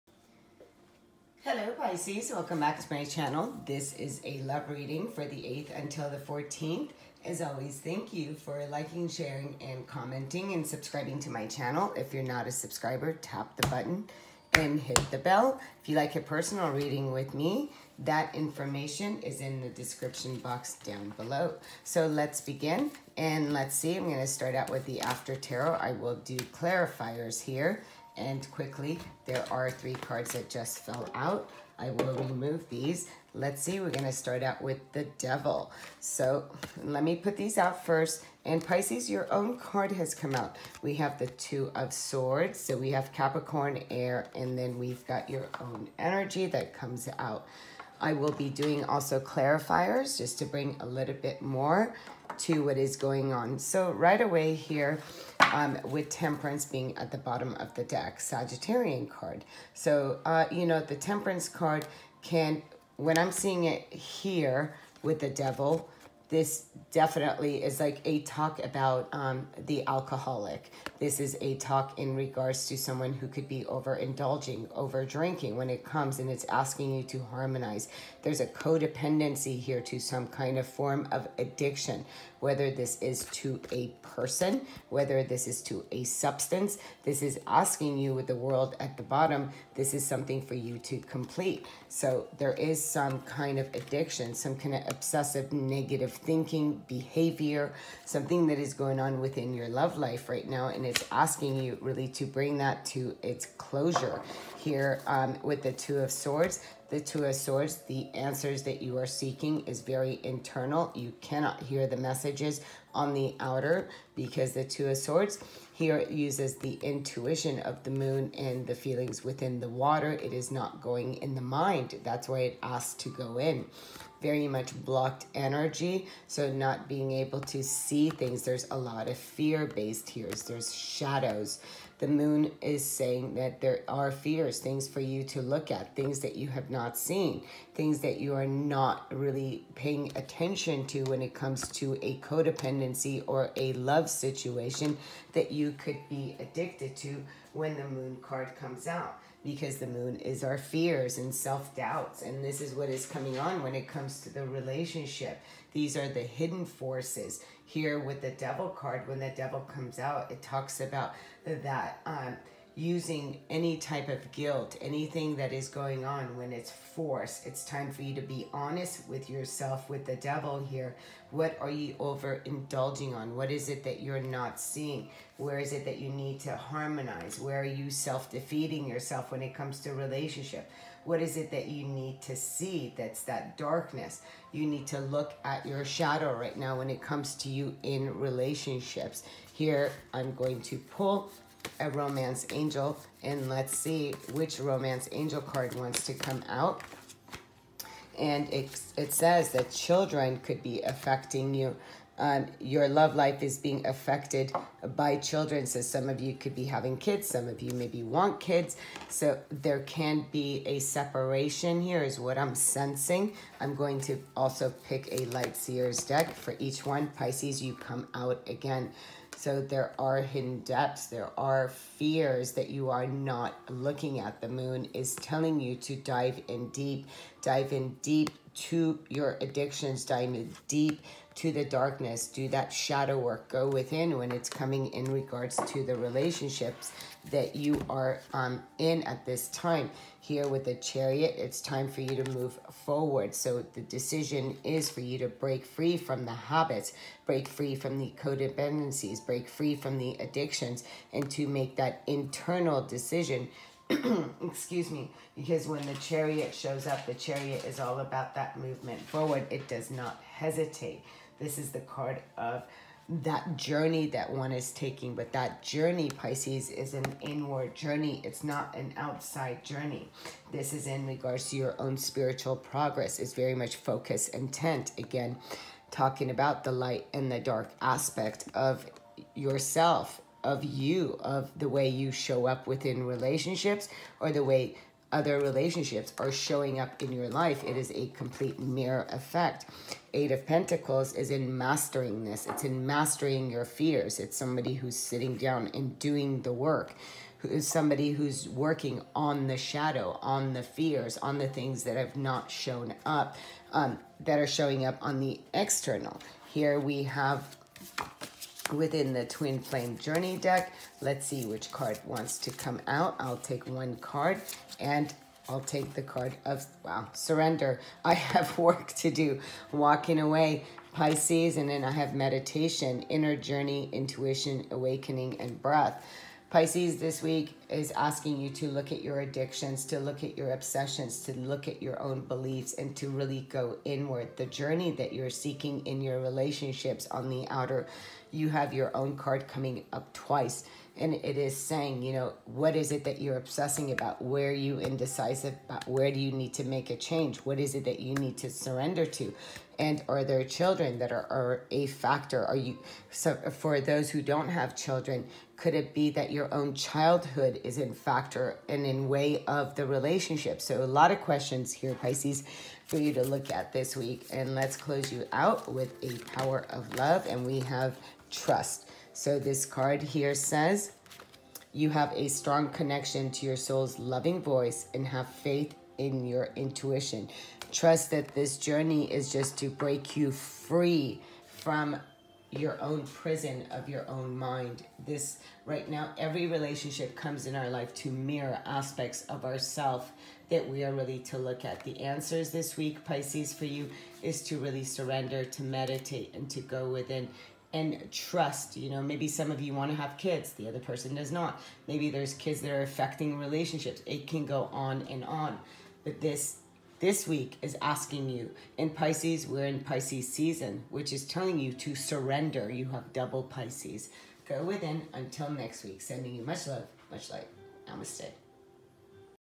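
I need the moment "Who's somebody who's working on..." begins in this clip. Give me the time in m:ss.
4:57.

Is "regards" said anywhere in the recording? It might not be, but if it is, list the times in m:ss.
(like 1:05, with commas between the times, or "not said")
1:12, 3:55, 4:31.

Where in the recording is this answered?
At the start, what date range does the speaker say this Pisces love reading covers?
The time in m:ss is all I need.
0:05.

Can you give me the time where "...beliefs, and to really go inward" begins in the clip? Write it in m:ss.
5:32.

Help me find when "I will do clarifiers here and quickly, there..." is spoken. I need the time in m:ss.
0:25.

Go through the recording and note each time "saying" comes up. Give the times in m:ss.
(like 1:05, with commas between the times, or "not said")
2:12, 5:41.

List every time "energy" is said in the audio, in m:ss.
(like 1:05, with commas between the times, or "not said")
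0:45, 2:05.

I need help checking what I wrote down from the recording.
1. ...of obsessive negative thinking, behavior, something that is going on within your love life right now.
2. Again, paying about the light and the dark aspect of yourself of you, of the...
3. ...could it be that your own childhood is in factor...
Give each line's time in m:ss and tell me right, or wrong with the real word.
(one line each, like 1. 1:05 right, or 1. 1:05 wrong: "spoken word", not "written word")
1. 1:34 right
2. 4:34 wrong: "talking", not "paying"
3. 5:55 right.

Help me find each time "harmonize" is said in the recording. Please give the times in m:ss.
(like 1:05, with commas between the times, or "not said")
1:17, 2:56.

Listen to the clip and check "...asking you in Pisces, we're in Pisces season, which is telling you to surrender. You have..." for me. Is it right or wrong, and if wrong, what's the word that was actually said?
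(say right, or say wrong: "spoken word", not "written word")
right.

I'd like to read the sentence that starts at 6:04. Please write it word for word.
And let's close you out with a power of love.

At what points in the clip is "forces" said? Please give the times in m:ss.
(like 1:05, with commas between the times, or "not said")
2:36, 2:46.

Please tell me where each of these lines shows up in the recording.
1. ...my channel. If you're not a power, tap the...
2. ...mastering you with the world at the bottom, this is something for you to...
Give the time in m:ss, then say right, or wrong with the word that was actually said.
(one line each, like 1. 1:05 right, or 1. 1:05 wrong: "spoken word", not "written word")
1. 0:11 wrong: "subscriber", not "power"
2. 1:27 wrong: "asking", not "mastering".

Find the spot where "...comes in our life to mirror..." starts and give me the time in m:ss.
6:27.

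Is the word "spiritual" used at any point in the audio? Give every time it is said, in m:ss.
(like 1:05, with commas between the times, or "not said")
4:31.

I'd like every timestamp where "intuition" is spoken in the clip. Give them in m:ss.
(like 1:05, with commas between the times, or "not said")
1:56, 5:23, 6:16.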